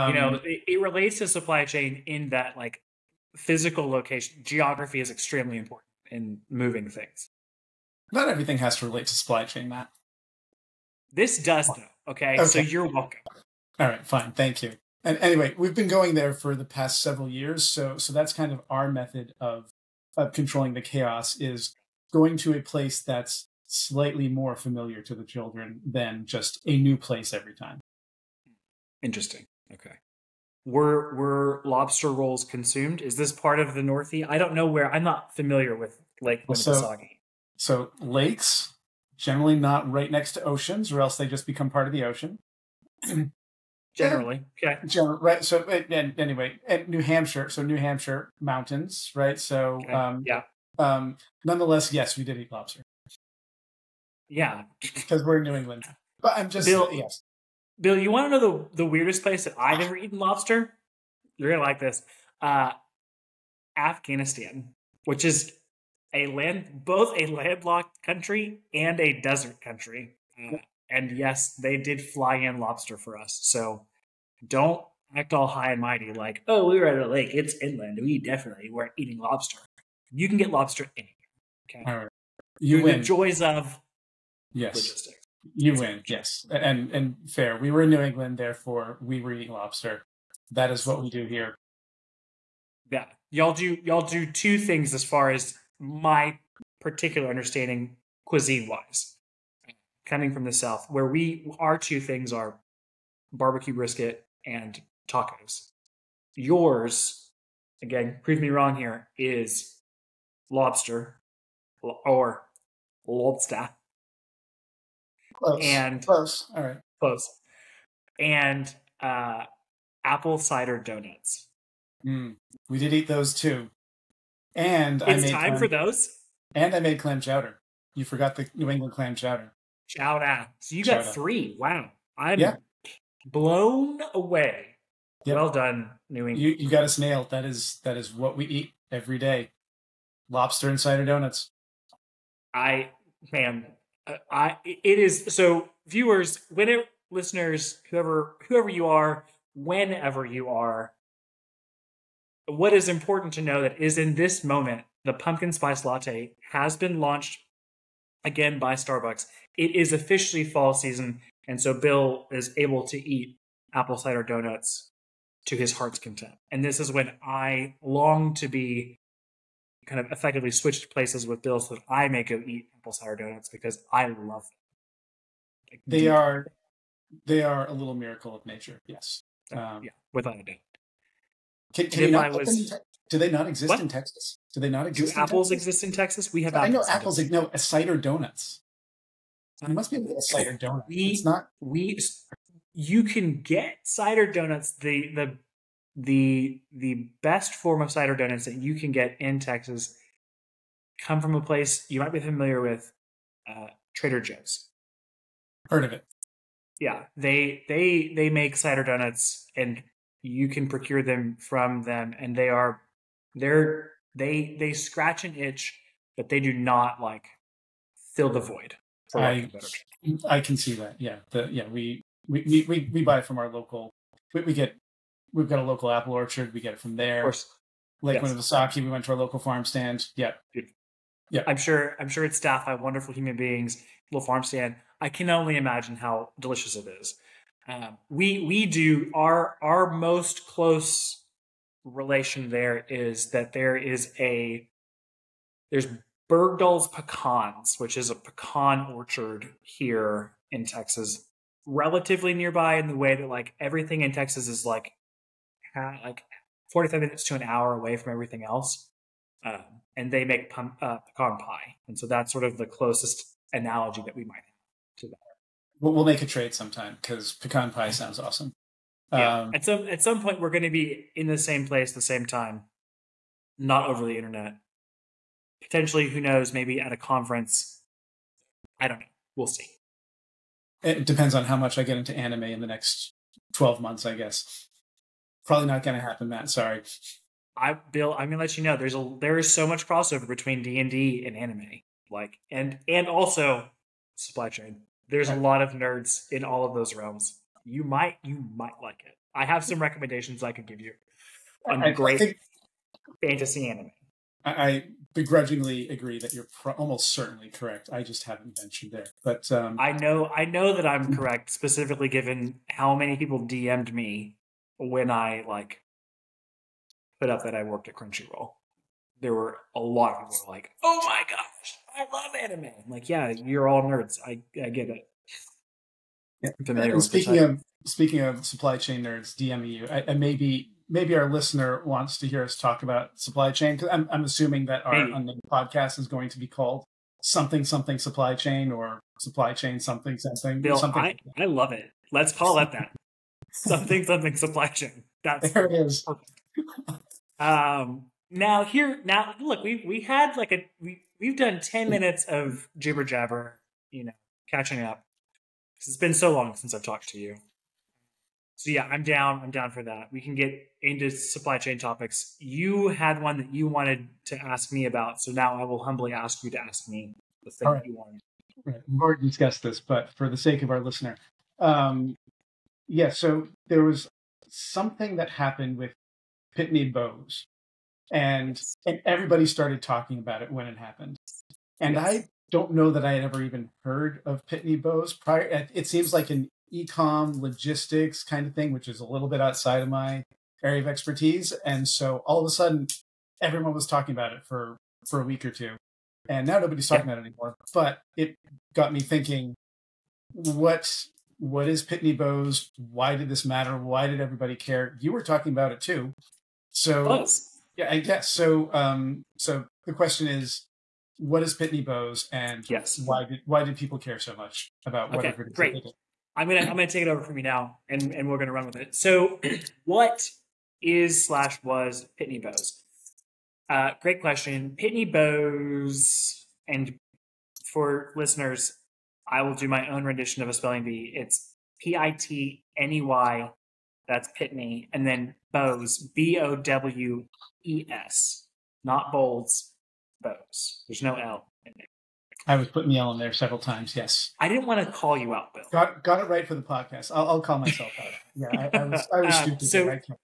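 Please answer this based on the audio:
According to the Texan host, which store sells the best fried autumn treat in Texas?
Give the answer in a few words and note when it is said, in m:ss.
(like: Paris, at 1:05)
Trader Joe's, at 3:23.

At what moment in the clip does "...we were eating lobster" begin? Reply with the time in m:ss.
1:28.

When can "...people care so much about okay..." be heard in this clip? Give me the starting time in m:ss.
6:53.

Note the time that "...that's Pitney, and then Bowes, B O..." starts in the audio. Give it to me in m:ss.
7:14.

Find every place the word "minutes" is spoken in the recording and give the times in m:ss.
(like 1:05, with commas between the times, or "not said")
4:16, 5:51.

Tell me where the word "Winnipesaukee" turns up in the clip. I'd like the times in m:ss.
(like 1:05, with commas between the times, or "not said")
0:36, 3:48.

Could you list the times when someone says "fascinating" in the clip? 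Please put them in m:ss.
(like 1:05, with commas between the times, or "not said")
not said.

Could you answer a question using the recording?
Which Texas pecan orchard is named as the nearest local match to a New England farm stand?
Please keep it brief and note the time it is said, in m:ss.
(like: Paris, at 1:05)
Berdoll's pecans, at 4:06.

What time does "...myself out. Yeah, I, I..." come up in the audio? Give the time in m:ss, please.
7:27.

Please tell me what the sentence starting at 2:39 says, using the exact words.
It is officially fall season, and so Bill is able to eat apple cider donuts to his heart's content.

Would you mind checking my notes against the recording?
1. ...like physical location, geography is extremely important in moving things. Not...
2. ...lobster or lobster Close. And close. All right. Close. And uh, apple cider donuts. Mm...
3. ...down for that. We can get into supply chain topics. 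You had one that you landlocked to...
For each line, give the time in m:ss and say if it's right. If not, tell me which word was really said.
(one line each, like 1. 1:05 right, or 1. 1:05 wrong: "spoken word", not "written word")
1. 0:02 right
2. 1:50 right
3. 5:59 wrong: "wanted", not "landlocked".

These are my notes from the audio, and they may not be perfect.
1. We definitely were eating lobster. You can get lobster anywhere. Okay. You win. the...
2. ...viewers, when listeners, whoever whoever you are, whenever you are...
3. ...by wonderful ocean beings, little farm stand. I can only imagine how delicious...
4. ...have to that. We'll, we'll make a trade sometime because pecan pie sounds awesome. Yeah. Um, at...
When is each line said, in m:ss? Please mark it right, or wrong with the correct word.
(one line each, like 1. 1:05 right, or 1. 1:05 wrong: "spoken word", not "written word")
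1. 1:18 right
2. 2:25 right
3. 3:52 wrong: "human", not "ocean"
4. 4:24 right.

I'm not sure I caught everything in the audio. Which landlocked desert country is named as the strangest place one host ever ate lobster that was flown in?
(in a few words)
Afghanistan.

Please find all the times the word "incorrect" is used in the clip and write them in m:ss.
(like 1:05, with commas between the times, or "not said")
not said.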